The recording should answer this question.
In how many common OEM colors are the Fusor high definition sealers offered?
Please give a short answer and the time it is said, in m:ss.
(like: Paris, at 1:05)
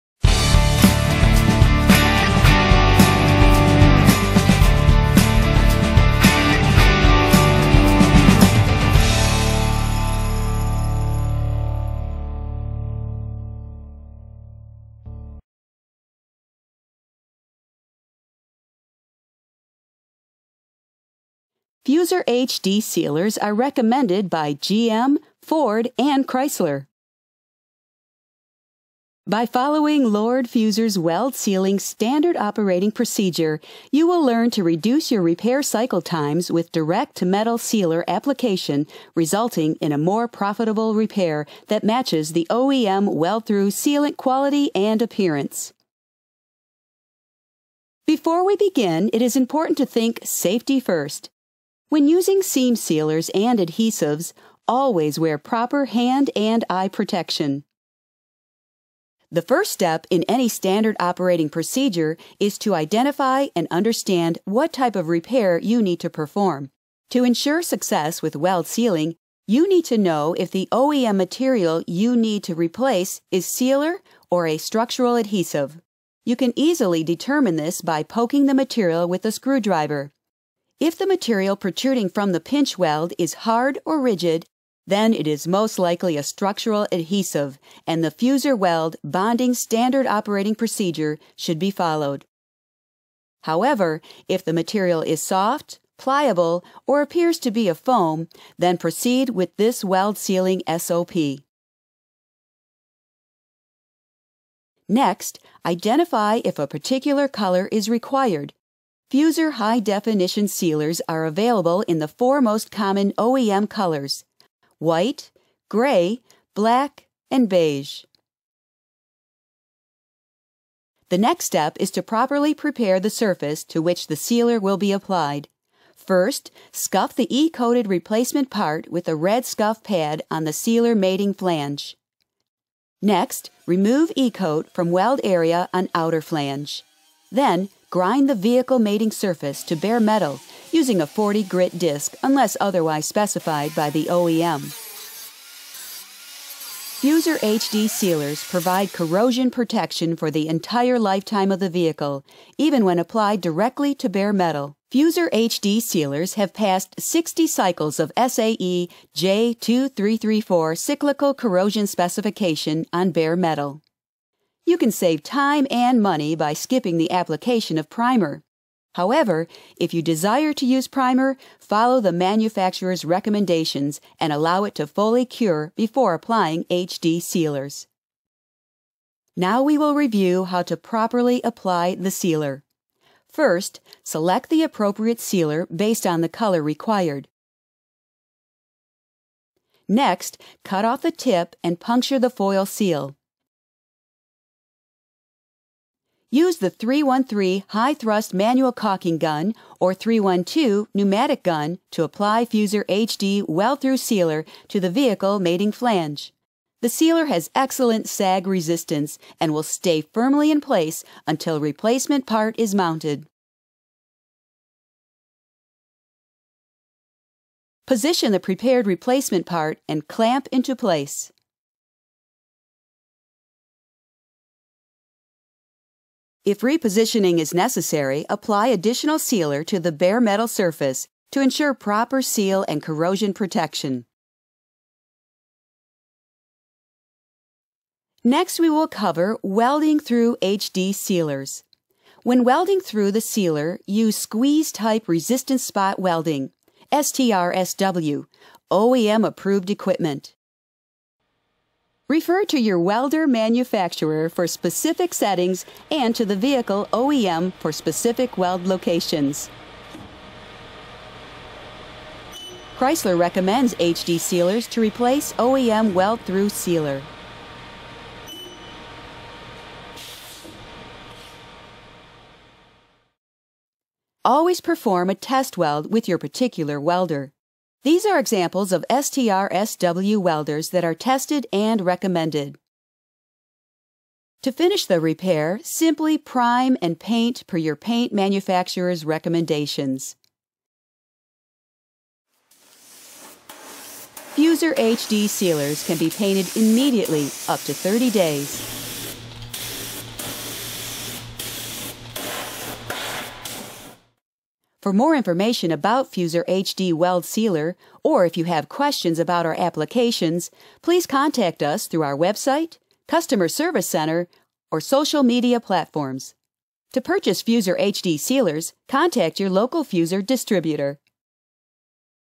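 4, at 1:52.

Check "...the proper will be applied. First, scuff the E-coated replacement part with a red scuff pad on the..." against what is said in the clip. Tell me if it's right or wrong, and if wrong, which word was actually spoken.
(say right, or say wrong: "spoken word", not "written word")
wrong: "sealer", not "proper".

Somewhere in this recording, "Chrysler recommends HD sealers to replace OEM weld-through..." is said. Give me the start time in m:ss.
4:22.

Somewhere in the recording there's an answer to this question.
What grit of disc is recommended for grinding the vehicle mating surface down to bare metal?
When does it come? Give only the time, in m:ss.
2:21.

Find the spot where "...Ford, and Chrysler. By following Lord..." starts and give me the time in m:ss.
0:25.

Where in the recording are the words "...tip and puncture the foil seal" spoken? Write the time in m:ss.
3:11.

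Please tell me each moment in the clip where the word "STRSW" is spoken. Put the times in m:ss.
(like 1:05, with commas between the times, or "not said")
4:06, 4:38.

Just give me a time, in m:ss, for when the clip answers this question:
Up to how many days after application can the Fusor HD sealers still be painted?
4:57.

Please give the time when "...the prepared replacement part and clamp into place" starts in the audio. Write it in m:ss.
3:38.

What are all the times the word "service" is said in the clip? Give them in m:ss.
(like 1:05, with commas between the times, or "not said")
5:13.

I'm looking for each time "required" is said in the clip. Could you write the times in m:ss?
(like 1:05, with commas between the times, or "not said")
1:47, 3:06.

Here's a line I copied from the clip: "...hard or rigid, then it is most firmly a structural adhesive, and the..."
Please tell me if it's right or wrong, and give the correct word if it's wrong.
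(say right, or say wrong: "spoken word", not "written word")
wrong: "likely", not "firmly".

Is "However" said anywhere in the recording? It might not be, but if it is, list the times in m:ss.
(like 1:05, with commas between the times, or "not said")
1:33, 2:48.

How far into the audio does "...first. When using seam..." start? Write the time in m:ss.
0:50.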